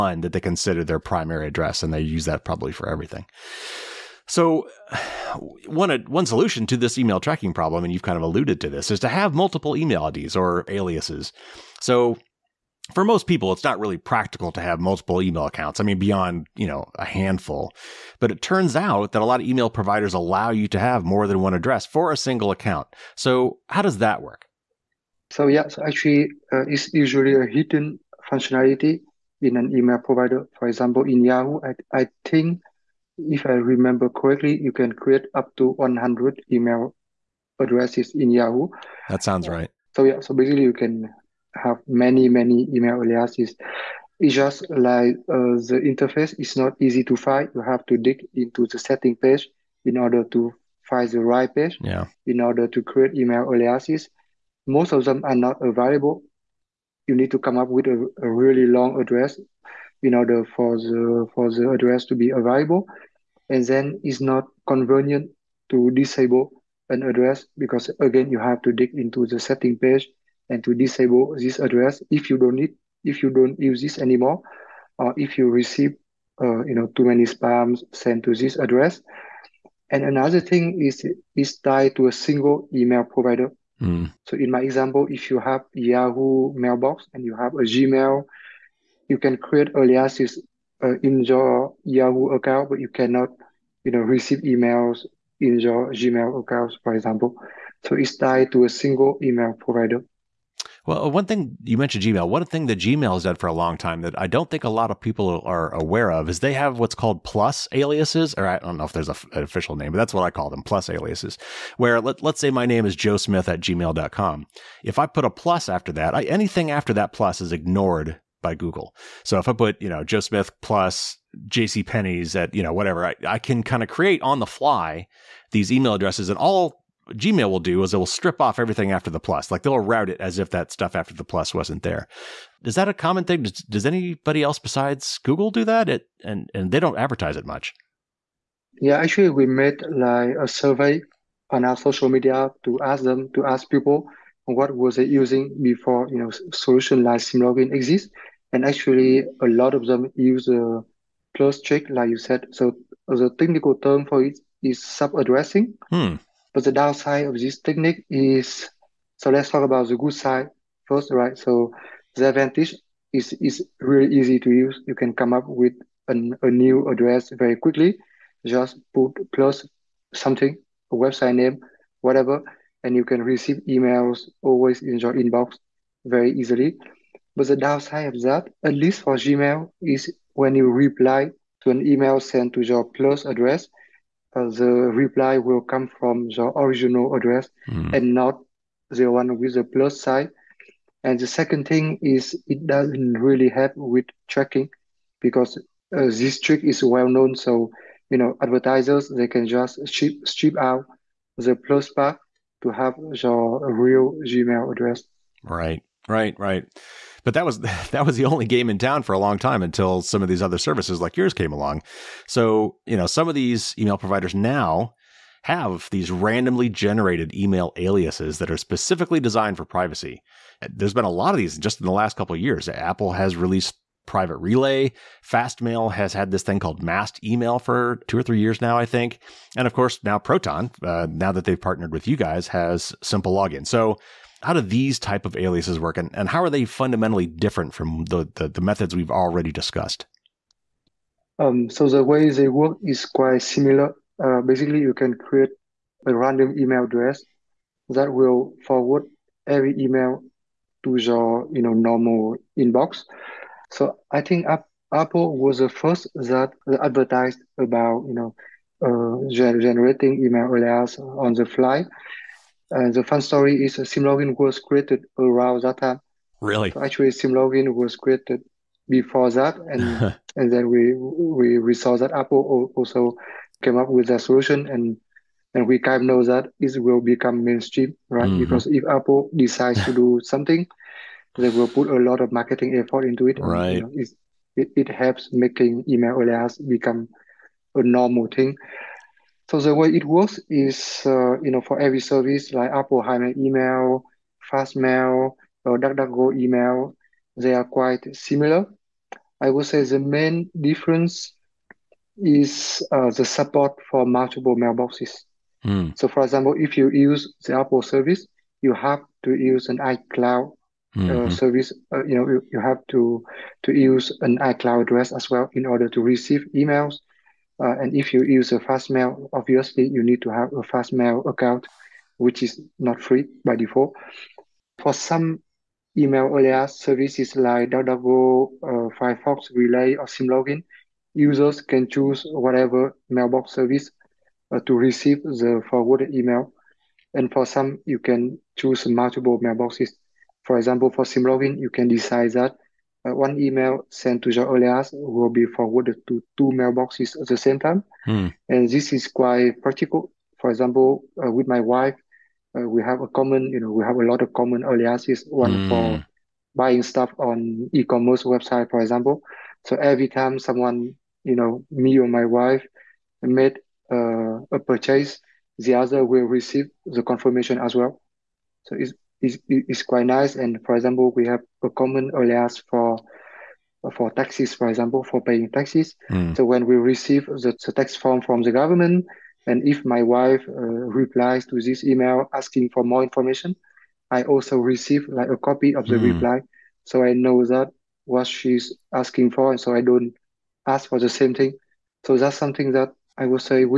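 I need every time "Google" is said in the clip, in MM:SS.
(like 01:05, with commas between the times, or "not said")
01:58, 02:15.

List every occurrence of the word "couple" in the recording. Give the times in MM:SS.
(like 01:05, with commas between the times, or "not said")
03:42.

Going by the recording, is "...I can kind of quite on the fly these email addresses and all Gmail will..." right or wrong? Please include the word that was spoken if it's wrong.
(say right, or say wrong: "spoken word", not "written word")
wrong: "create", not "quite".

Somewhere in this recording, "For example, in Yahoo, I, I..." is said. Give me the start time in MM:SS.
00:30.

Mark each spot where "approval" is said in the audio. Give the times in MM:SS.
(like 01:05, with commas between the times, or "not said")
not said.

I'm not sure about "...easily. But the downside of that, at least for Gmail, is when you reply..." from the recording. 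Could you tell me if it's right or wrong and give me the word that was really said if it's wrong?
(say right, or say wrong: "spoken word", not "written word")
right.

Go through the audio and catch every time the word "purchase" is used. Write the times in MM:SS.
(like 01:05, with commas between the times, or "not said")
06:04.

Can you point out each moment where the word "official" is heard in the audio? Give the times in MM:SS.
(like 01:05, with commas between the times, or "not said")
01:49.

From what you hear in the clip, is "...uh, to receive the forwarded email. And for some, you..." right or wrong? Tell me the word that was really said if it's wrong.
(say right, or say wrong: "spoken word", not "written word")
right.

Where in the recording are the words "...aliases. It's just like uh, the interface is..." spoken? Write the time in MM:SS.
00:43.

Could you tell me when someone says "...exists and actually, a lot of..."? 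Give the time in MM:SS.
02:27.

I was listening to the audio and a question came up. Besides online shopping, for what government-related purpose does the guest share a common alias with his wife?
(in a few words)
Paying taxes.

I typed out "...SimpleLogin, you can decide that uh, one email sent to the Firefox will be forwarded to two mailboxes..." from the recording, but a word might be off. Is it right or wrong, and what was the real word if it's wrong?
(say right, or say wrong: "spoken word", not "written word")
wrong: "Olias", not "Firefox".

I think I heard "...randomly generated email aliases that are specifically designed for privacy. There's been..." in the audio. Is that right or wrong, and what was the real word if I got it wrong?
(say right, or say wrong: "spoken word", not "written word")
right.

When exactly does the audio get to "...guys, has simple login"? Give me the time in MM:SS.
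03:52.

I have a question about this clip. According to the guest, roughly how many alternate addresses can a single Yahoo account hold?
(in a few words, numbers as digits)
100.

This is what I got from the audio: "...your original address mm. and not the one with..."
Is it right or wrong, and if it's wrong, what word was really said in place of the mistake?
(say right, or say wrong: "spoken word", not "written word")
right.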